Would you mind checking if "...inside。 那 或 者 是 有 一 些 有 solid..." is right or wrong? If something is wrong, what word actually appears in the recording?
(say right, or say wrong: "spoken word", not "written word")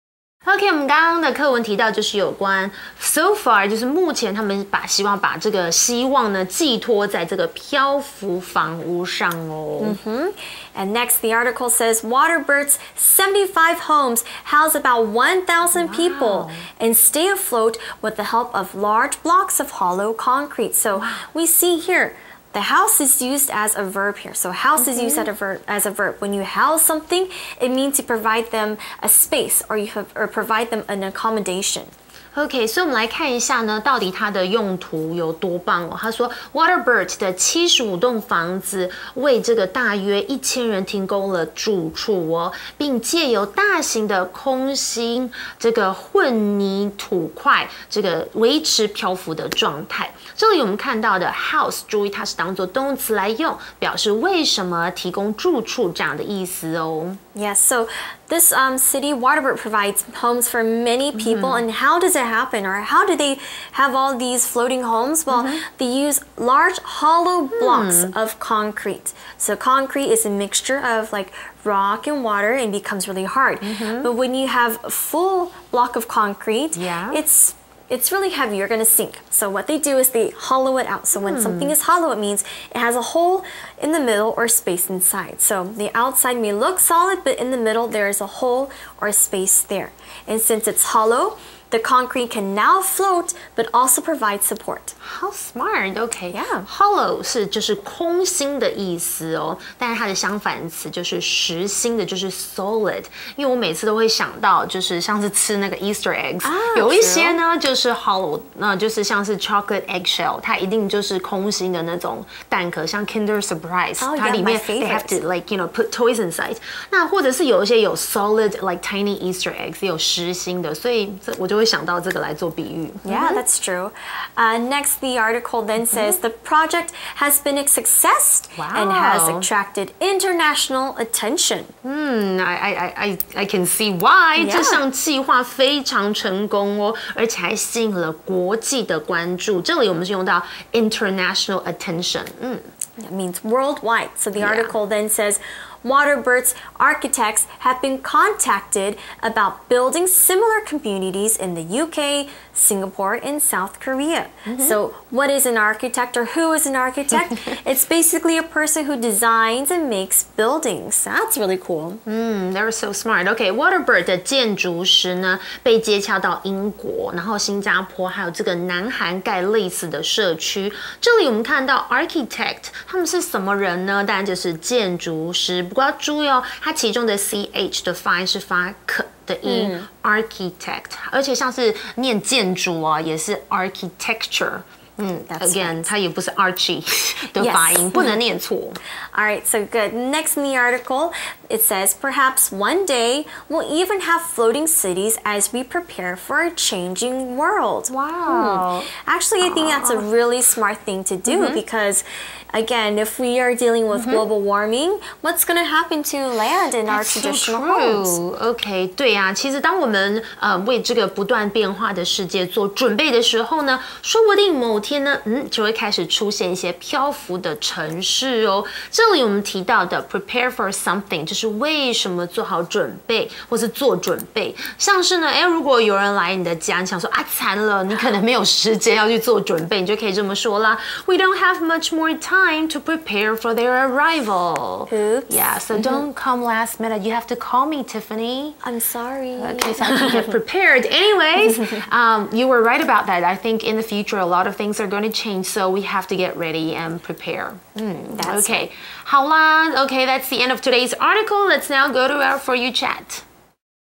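right.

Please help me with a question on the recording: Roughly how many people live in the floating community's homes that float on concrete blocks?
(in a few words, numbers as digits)
1,000.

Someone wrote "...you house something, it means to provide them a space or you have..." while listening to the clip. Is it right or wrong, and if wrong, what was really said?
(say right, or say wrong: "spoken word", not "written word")
right.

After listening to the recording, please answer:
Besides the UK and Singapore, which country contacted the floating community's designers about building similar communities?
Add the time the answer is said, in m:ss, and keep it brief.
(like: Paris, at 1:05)
South Korea, at 2:33.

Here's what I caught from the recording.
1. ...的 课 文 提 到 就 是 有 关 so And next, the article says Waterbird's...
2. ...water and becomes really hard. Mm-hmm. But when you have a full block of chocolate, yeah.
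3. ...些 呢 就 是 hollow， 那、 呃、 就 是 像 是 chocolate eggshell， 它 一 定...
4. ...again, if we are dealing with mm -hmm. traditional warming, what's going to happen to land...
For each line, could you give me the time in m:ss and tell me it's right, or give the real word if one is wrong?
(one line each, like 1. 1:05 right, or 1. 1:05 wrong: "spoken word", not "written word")
1. 0:01 right
2. 1:12 wrong: "concrete", not "chocolate"
3. 1:47 right
4. 3:22 wrong: "global", not "traditional".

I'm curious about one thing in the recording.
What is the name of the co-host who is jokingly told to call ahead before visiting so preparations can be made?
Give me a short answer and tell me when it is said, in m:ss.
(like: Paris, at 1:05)
Tiffany, at 3:57.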